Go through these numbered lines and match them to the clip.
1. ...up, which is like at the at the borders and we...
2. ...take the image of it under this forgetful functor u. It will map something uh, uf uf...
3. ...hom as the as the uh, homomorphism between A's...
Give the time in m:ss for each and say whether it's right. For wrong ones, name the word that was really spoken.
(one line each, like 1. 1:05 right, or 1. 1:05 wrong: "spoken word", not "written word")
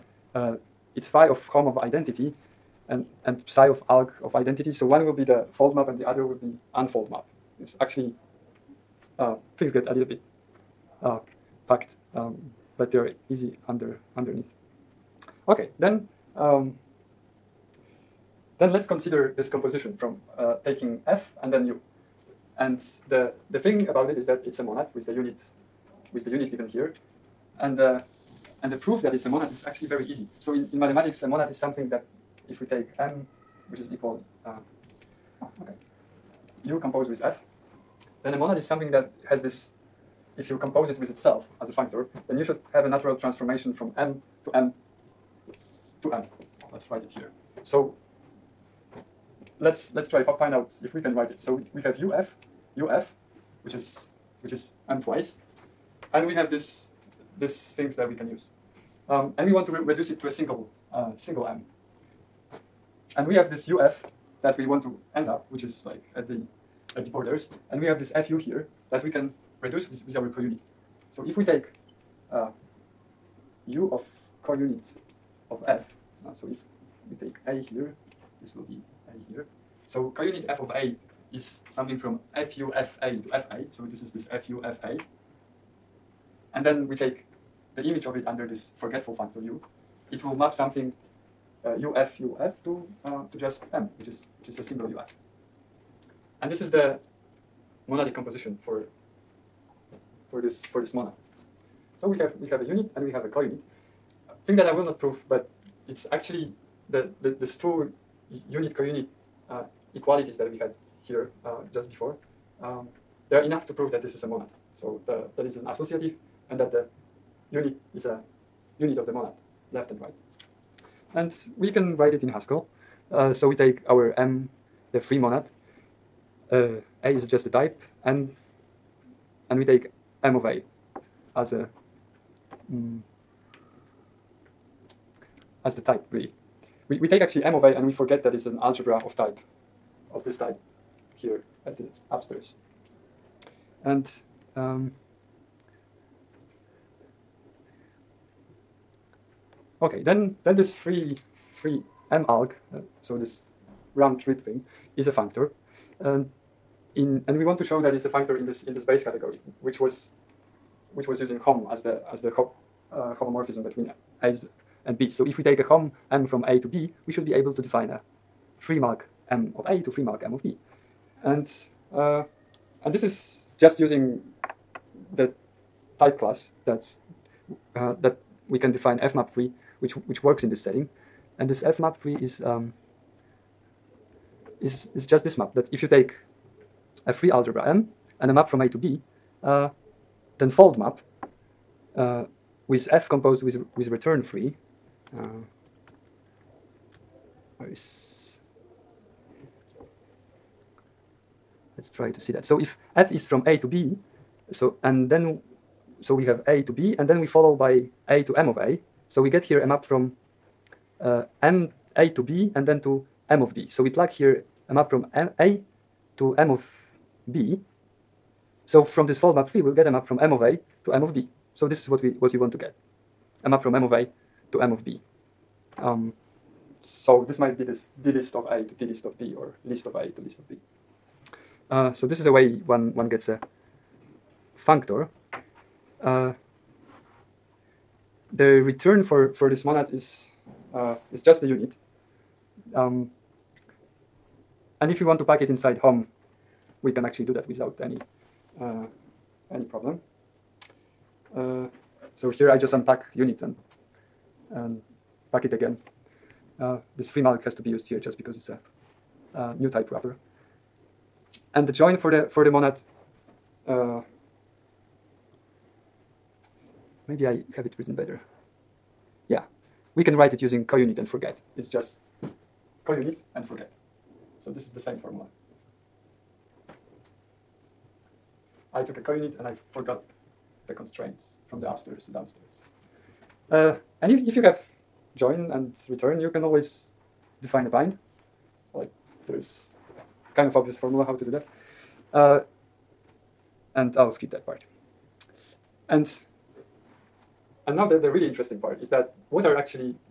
1. 1:05 right
2. 1:26 right
3. 2:41 right.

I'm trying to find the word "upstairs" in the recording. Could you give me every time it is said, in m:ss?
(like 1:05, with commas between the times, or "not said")
2:22, 4:41.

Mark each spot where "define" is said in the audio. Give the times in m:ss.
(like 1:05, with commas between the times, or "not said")
2:47, 2:58, 4:47.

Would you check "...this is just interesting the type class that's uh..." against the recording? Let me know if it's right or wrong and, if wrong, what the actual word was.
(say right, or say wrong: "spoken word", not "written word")
wrong: "using", not "interesting".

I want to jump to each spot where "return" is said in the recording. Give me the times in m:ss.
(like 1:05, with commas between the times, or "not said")
3:13, 3:58, 4:45.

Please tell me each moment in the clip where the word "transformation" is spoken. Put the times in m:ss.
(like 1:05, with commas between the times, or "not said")
0:43.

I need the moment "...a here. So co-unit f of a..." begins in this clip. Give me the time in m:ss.
1:19.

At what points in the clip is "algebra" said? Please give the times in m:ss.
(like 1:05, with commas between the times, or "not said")
2:18, 3:07.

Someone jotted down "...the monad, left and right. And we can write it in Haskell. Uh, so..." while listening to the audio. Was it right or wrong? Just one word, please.
right.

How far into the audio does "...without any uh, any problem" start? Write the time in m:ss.
4:07.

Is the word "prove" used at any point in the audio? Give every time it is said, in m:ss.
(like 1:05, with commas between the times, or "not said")
1:44, 1:53.